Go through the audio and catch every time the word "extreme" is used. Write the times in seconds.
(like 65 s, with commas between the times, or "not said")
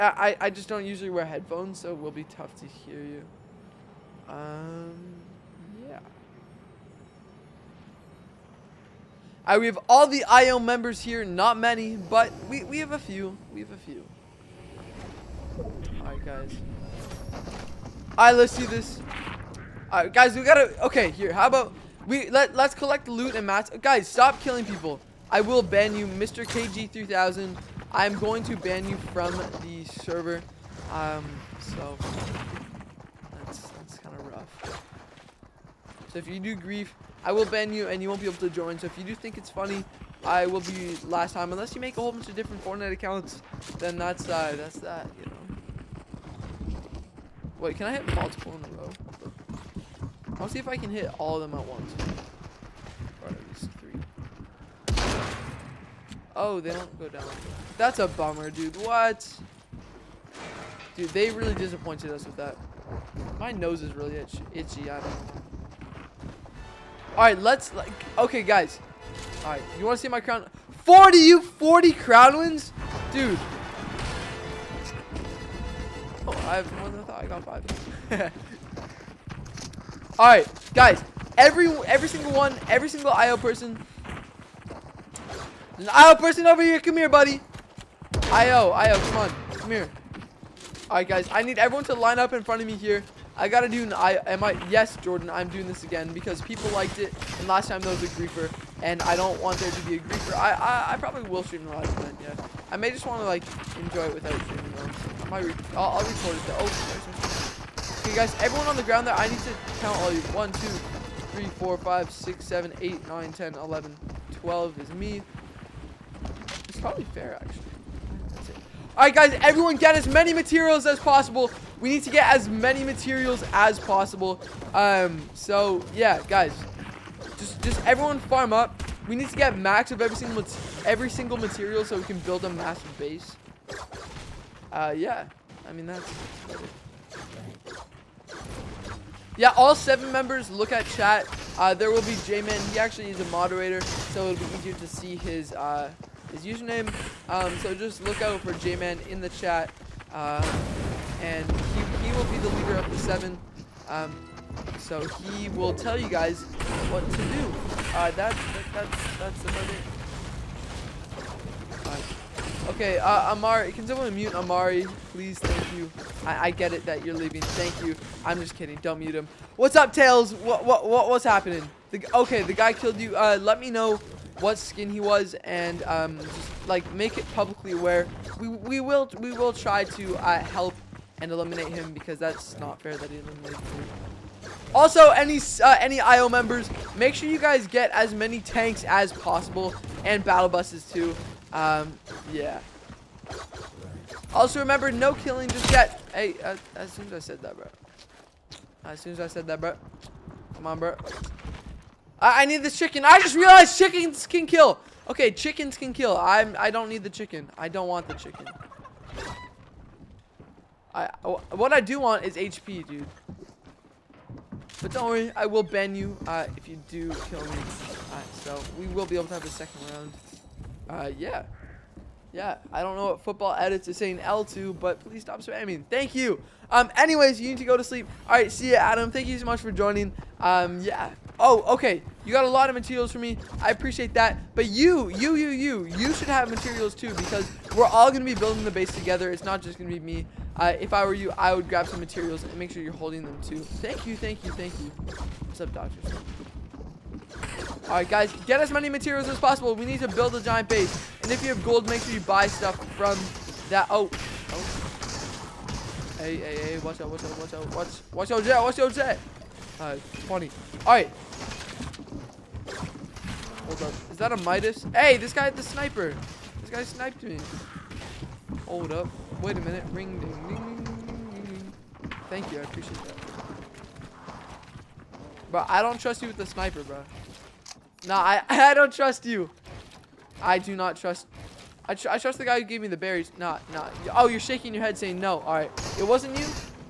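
not said.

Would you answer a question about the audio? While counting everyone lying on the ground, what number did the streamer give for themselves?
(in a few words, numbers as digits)
12.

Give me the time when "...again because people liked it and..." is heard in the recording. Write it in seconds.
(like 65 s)
95 s.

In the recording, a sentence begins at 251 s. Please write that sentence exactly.
And if you have gold, make sure you buy stuff from that.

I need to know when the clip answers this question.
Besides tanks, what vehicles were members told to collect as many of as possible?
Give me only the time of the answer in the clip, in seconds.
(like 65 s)
190 s.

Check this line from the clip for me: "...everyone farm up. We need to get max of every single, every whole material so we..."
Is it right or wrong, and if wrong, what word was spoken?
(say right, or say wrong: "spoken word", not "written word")
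wrong: "single", not "whole".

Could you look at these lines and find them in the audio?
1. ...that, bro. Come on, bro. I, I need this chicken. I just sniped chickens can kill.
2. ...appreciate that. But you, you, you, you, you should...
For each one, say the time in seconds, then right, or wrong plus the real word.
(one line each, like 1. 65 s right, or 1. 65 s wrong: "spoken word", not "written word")
1. 199 s wrong: "realized", not "sniped"
2. 233 s right.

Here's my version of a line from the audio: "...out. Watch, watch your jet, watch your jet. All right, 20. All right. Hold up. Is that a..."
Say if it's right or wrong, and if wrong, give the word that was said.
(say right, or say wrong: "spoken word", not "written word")
right.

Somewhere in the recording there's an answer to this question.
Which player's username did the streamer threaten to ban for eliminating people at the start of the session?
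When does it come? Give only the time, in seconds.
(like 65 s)
26 s.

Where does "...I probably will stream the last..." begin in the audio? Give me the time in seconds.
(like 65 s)
100 s.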